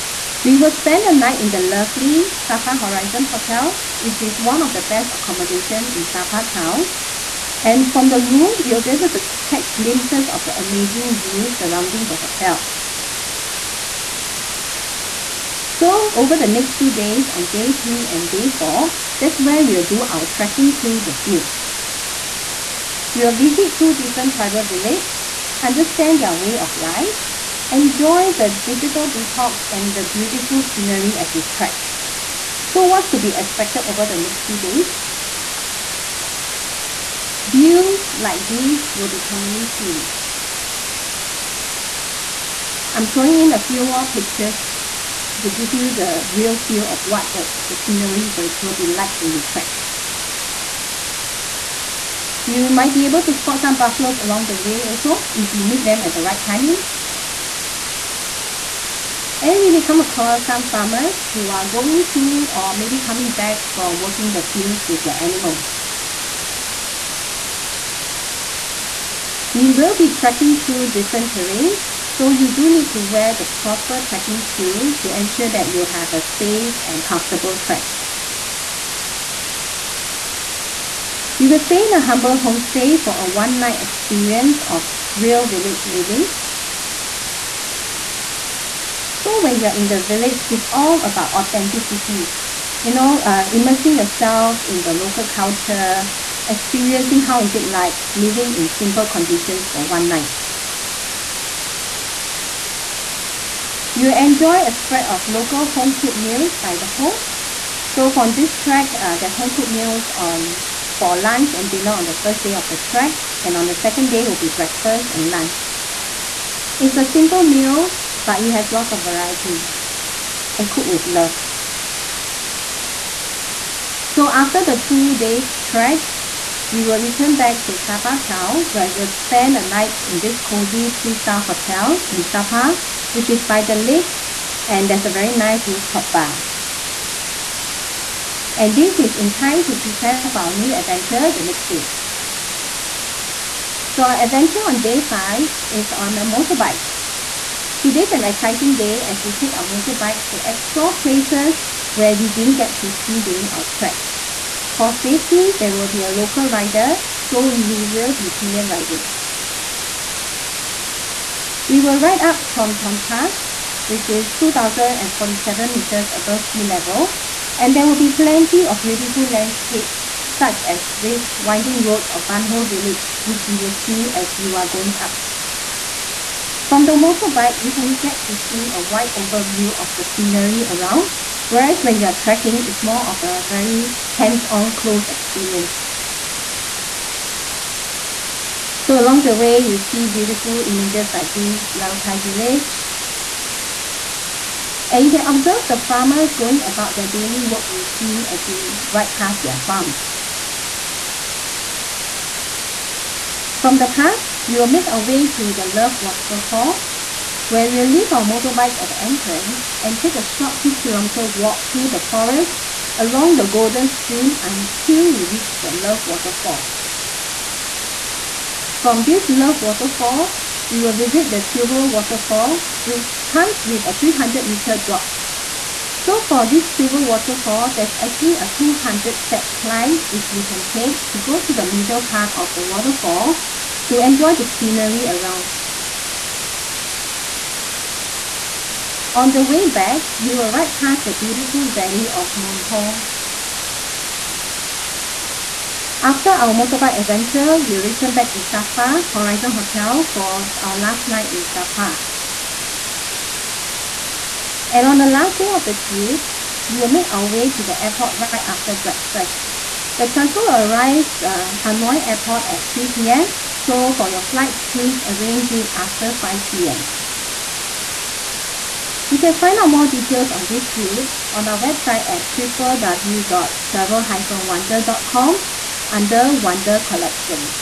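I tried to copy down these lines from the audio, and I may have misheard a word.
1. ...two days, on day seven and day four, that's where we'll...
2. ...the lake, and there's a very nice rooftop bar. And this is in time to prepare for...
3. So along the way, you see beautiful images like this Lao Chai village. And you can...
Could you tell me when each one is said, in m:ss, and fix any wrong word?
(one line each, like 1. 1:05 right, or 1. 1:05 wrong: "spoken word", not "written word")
1. 0:16 wrong: "three", not "seven"
2. 2:13 right
3. 3:08 right.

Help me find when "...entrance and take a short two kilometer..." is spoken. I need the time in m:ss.
3:29.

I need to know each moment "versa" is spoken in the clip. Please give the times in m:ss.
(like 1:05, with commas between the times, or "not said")
not said.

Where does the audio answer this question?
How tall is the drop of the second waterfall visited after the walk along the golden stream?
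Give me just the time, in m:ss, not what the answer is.
3:43.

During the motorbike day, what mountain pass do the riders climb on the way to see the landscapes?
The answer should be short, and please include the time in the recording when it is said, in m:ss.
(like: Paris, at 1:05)
Tram Ton Pass, at 2:42.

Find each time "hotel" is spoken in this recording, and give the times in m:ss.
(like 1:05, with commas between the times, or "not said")
0:03, 0:12, 2:11, 4:09.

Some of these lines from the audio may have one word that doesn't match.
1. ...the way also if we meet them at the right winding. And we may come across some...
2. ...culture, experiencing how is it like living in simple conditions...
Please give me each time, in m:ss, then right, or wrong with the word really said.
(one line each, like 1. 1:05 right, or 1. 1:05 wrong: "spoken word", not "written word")
1. 0:54 wrong: "timing", not "winding"
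2. 1:35 right.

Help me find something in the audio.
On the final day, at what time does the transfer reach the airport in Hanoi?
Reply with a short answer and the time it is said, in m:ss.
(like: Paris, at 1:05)
3 p.m., at 4:22.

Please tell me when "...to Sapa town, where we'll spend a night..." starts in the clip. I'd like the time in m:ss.
2:07.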